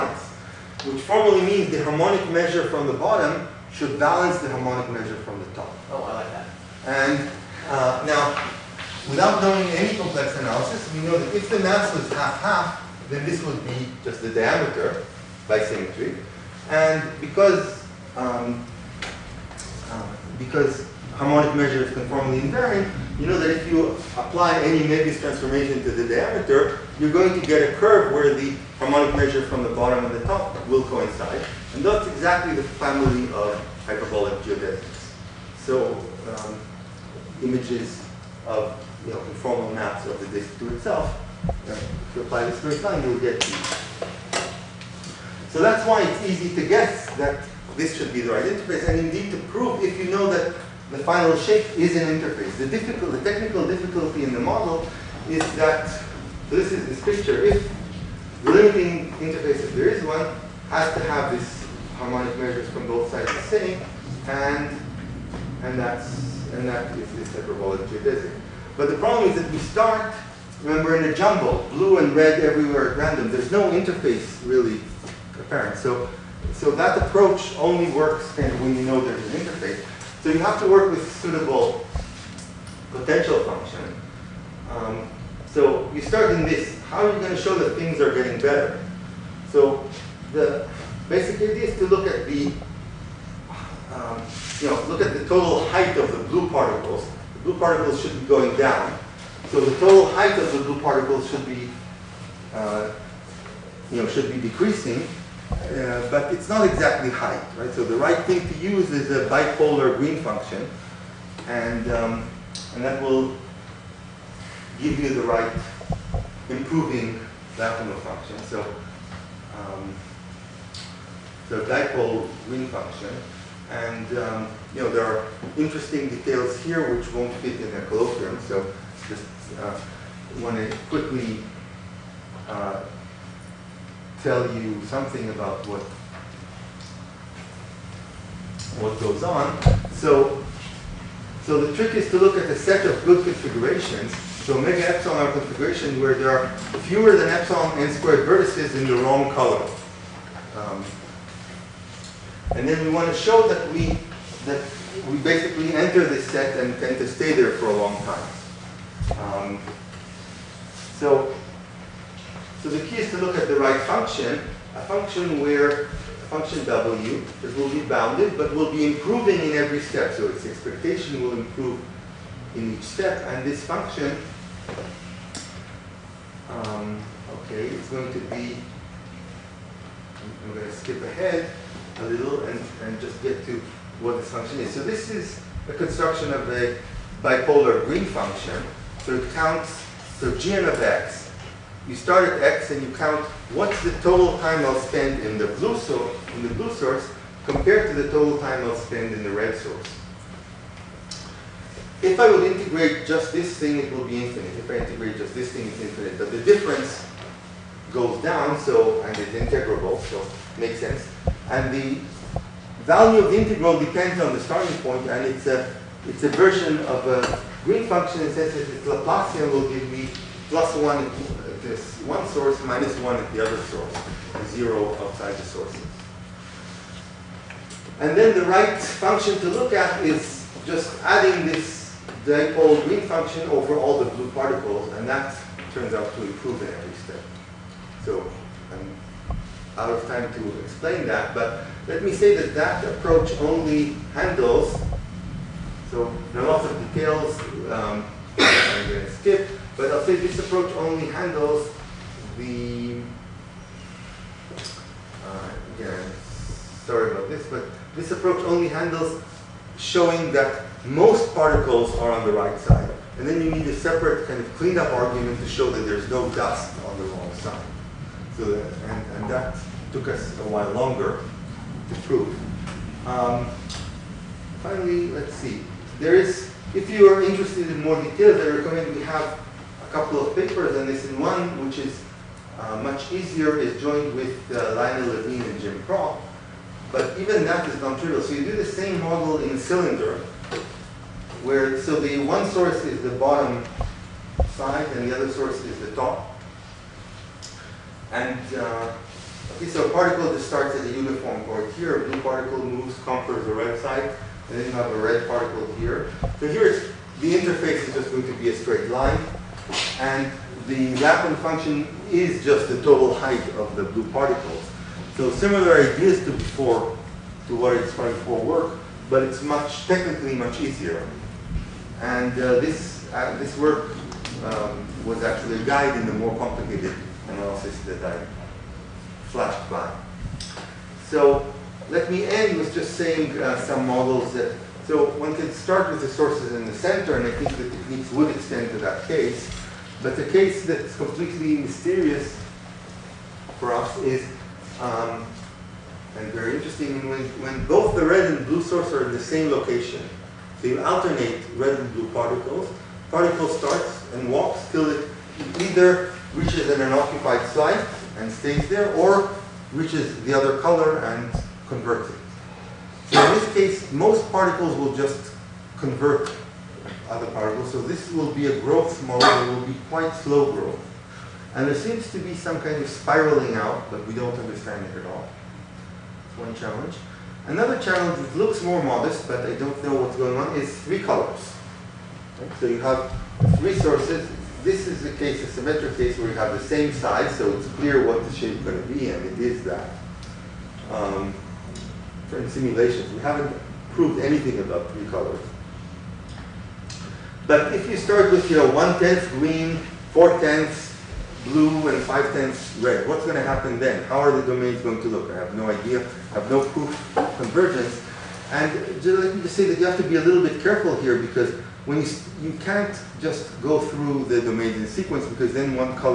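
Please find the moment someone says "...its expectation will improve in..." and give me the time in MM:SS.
02:50.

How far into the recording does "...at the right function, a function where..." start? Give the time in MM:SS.
02:43.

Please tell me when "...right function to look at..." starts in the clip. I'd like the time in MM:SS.
03:48.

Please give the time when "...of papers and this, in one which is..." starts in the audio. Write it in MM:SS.
04:40.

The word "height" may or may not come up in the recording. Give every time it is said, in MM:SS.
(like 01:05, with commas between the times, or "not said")
01:35, 01:40, 01:47, 05:13.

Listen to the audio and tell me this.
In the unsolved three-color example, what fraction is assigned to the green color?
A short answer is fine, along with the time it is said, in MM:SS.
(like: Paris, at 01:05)
One-tenth, at 06:38.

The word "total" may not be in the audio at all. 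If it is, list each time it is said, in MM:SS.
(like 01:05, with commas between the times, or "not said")
01:35, 01:39, 03:14, 03:18, 05:12.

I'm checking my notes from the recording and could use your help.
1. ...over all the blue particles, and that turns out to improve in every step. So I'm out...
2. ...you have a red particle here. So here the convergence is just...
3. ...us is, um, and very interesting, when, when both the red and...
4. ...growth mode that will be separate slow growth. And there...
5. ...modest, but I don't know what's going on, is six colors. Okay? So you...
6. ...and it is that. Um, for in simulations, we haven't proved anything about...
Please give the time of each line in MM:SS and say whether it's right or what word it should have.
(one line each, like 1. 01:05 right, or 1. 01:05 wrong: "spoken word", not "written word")
1. 03:53 right
2. 05:04 wrong: "interface", not "convergence"
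3. 05:43 right
4. 06:08 wrong: "quite", not "separate"
5. 06:18 wrong: "three", not "six"
6. 06:29 right.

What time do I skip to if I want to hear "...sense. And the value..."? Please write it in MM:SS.
03:30.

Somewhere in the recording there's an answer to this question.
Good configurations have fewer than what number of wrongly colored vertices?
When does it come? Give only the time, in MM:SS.
02:27.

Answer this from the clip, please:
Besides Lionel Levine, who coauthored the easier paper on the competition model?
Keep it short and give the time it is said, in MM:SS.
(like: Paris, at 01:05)
Jim Propp, at 04:45.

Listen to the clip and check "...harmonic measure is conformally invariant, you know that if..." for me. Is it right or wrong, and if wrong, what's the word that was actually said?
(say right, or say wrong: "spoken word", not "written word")
right.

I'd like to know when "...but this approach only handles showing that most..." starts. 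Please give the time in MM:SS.
04:17.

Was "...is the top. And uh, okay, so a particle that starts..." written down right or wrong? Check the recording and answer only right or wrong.
right.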